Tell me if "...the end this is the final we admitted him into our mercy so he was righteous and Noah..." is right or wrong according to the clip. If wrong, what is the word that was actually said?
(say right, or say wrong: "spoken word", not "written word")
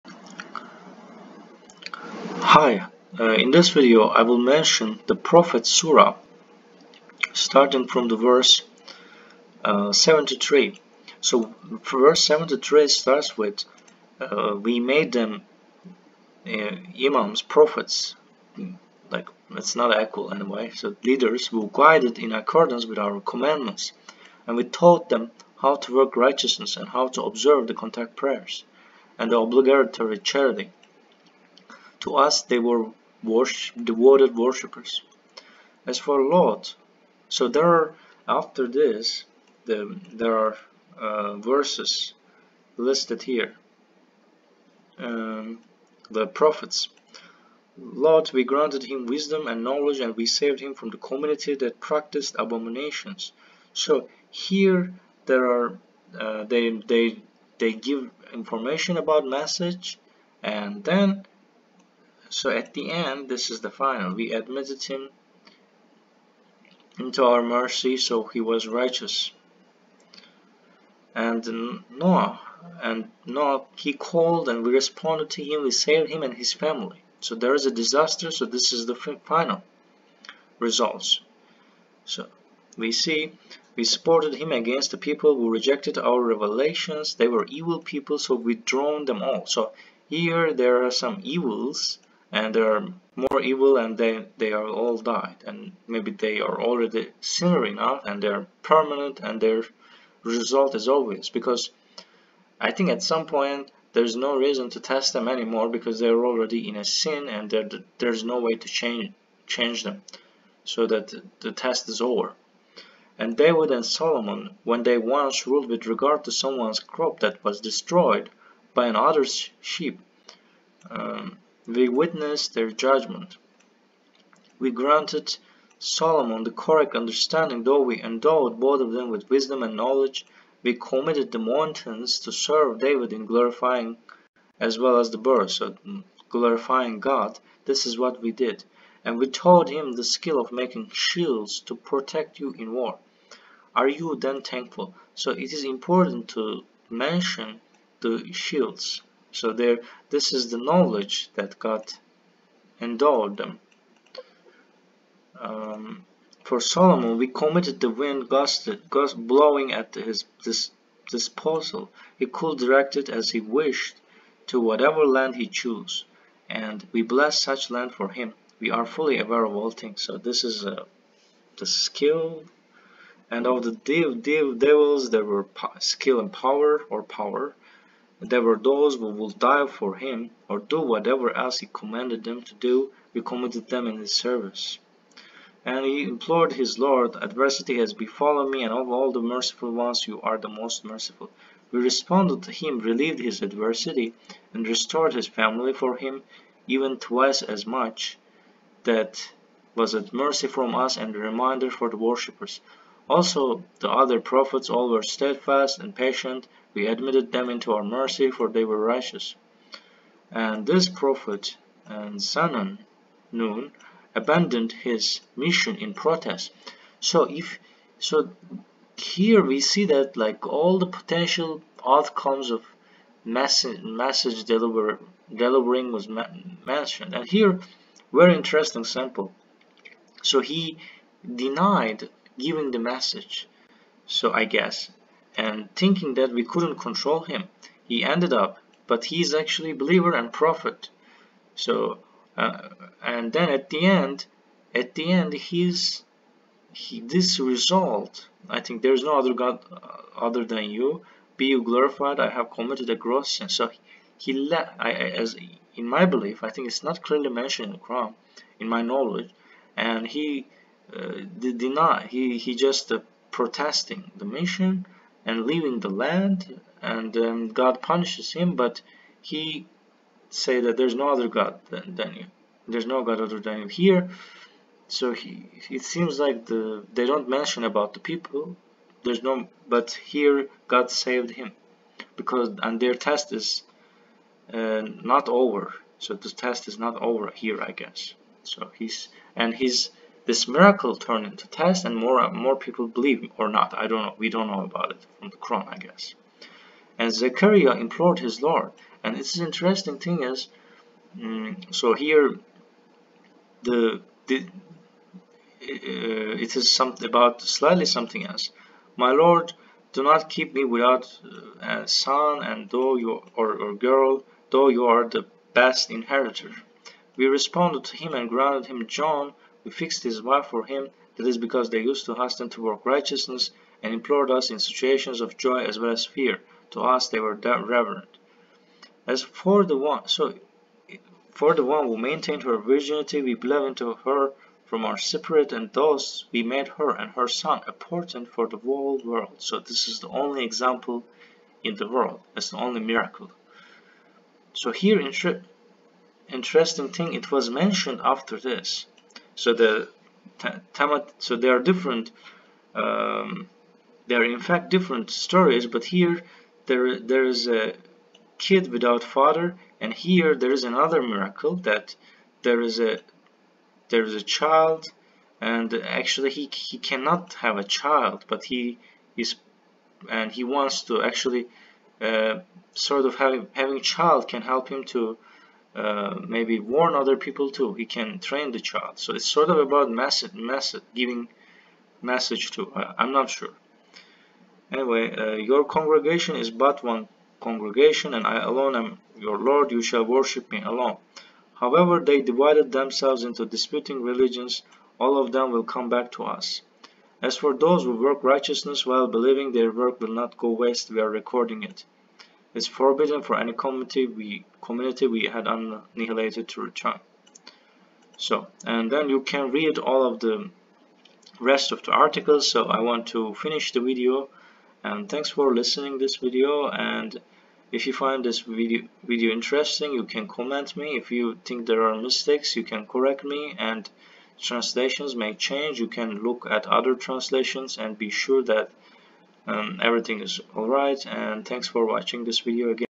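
right.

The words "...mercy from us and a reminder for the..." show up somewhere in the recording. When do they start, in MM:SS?
03:20.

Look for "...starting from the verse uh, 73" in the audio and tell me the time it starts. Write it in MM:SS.
00:07.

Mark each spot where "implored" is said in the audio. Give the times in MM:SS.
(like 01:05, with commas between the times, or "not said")
03:06, 04:57, 05:23.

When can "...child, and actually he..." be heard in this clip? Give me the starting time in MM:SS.
06:04.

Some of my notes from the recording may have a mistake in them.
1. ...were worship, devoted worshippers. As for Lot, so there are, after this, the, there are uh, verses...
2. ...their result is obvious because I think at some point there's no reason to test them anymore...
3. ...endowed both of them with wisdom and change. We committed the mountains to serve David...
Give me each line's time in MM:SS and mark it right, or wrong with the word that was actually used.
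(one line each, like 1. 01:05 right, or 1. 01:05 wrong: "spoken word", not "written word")
1. 00:32 right
2. 01:39 right
3. 02:08 wrong: "knowledge", not "change".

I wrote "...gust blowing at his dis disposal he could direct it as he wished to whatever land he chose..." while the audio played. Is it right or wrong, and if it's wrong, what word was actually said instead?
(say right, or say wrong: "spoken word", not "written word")
right.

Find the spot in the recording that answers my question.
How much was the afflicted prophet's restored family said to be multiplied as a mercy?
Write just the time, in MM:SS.
03:16.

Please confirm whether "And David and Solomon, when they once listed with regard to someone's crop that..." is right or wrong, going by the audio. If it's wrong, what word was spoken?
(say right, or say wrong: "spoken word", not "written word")
wrong: "ruled", not "listed".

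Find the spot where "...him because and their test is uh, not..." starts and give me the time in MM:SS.
04:41.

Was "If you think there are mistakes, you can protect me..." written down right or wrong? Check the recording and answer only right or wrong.
wrong.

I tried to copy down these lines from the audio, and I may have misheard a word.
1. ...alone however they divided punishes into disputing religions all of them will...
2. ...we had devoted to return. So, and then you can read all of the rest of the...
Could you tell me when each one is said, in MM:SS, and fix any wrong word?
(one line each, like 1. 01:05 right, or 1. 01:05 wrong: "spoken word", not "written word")
1. 06:30 wrong: "themselves", not "punishes"
2. 06:45 wrong: "annihilated", not "devoted".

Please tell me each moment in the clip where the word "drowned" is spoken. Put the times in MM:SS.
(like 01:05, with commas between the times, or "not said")
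01:28.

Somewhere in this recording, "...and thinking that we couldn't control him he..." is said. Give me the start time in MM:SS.
03:55.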